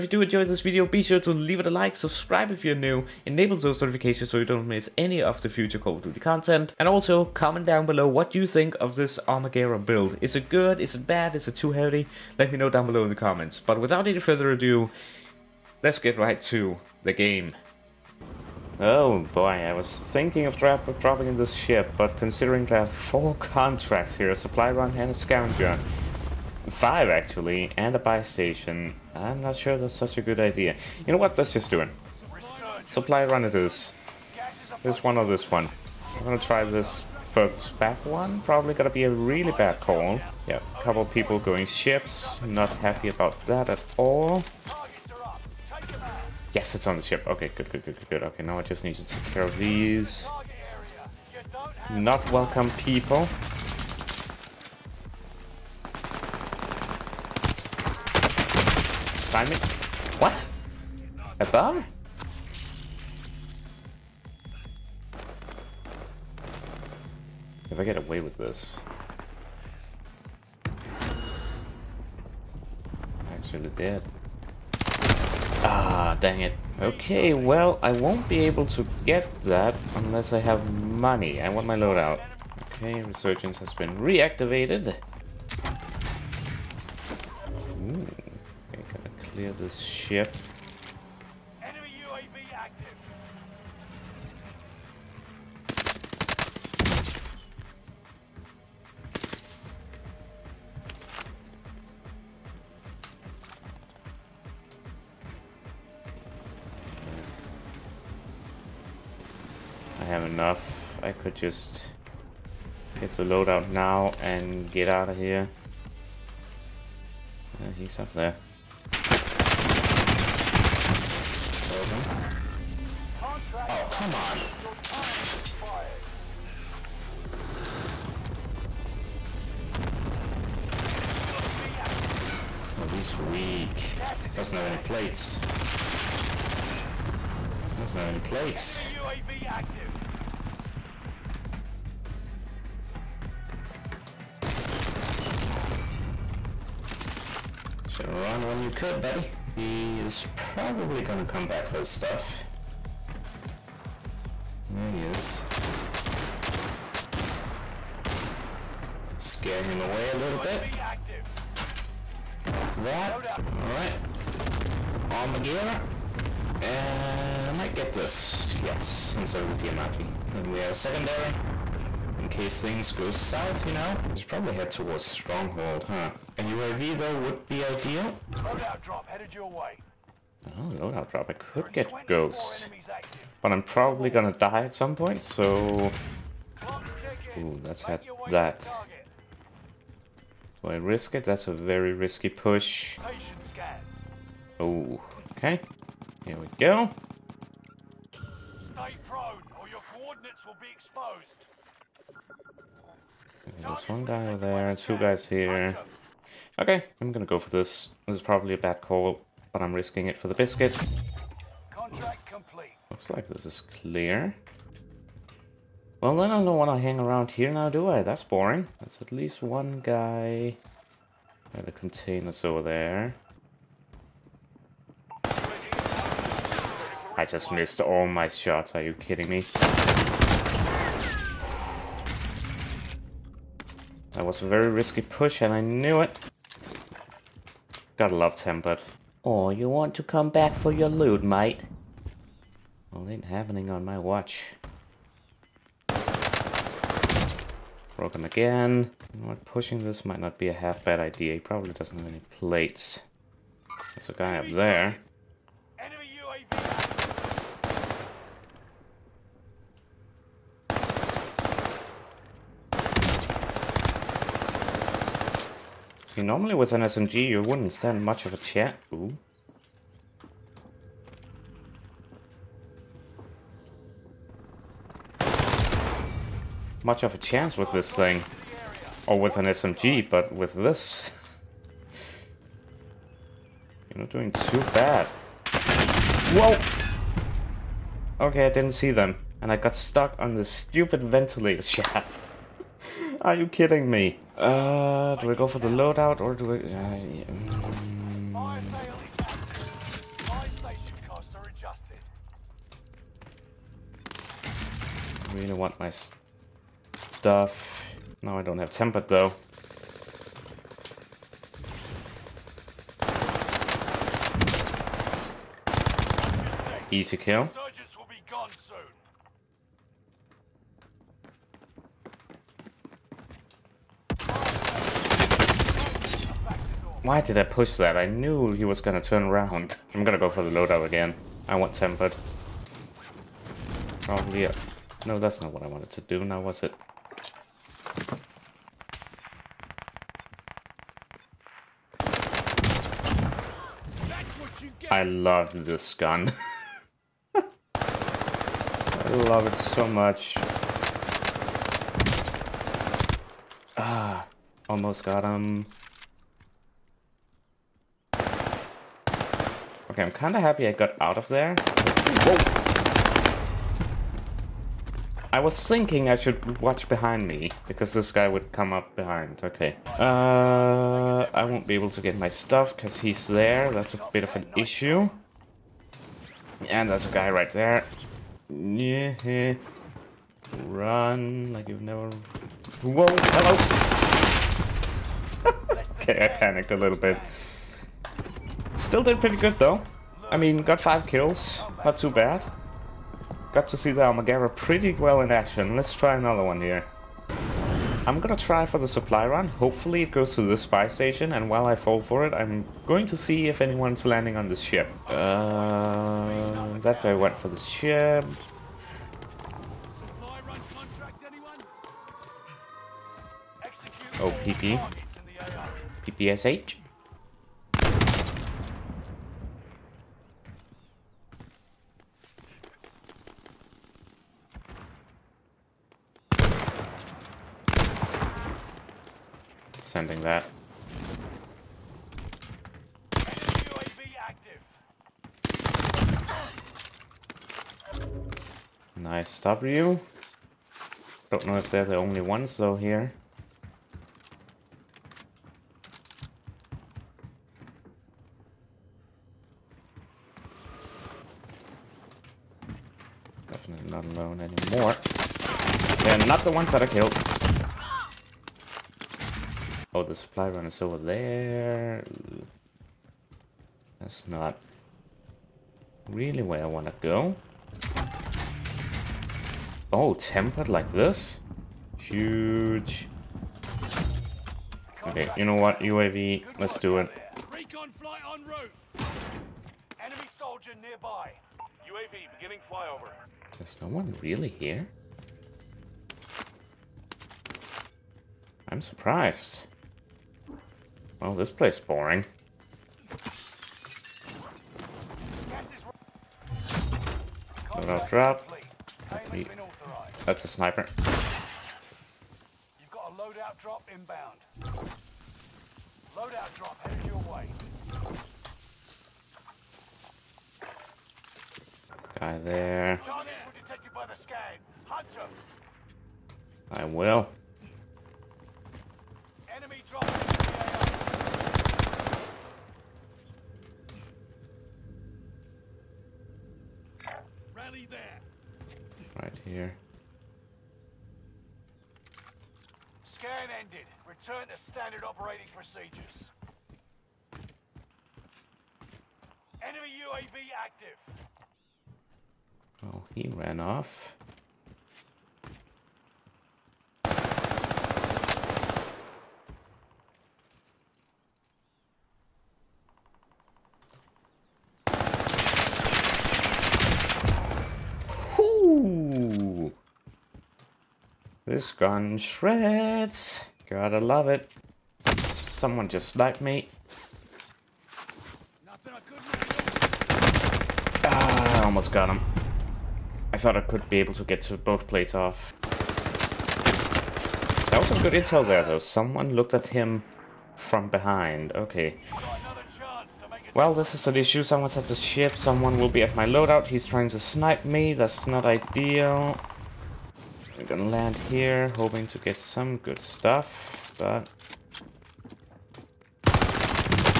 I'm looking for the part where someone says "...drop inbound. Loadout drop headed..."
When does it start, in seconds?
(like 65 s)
503 s.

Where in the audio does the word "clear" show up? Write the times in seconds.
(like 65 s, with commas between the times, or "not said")
89 s, 213 s.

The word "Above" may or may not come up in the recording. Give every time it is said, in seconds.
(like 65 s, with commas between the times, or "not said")
61 s.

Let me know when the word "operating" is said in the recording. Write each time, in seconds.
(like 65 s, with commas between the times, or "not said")
535 s.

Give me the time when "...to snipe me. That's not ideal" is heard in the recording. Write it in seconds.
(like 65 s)
587 s.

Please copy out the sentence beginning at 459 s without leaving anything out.
Oh, the supply run is over there.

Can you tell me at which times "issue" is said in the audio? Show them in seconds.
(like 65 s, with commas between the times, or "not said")
374 s, 584 s.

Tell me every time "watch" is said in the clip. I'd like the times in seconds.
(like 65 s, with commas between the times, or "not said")
243 s, 366 s.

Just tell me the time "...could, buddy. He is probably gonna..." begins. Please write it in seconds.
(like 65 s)
148 s.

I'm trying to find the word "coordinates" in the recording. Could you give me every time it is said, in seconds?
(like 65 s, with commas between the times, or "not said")
199 s.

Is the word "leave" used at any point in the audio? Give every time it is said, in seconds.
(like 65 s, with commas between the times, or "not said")
1 s.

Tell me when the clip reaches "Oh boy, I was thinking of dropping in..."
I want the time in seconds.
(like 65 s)
18 s.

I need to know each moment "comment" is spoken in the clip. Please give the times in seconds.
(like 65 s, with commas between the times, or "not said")
7 s, 13 s.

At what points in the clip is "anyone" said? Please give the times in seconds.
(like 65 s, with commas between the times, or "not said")
403 s.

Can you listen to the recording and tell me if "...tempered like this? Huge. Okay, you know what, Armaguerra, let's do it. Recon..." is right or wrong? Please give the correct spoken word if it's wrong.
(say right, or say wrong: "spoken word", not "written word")
wrong: "UAV", not "Armaguerra".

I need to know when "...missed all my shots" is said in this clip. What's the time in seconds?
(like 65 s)
227 s.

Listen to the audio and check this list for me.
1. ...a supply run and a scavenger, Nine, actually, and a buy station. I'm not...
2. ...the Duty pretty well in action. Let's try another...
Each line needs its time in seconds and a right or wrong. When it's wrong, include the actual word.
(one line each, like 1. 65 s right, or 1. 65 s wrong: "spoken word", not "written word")
1. 24 s wrong: "Five", not "Nine"
2. 393 s wrong: "Armaguerra", not "Duty".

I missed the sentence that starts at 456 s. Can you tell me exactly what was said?
They're not the ones that I killed.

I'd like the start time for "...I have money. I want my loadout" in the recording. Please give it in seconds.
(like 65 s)
80 s.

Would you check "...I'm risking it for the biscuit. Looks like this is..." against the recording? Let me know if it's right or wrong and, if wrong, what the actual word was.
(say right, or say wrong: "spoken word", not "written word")
right.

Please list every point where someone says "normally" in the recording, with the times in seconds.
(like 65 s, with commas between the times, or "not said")
266 s.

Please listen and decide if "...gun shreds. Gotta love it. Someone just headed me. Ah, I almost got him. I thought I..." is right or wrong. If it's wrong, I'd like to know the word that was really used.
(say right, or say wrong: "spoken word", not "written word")
wrong: "sniped", not "headed".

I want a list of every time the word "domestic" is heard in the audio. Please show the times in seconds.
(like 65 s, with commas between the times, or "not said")
not said.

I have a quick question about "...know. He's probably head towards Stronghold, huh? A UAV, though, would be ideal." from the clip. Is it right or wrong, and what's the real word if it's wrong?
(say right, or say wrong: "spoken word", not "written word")
right.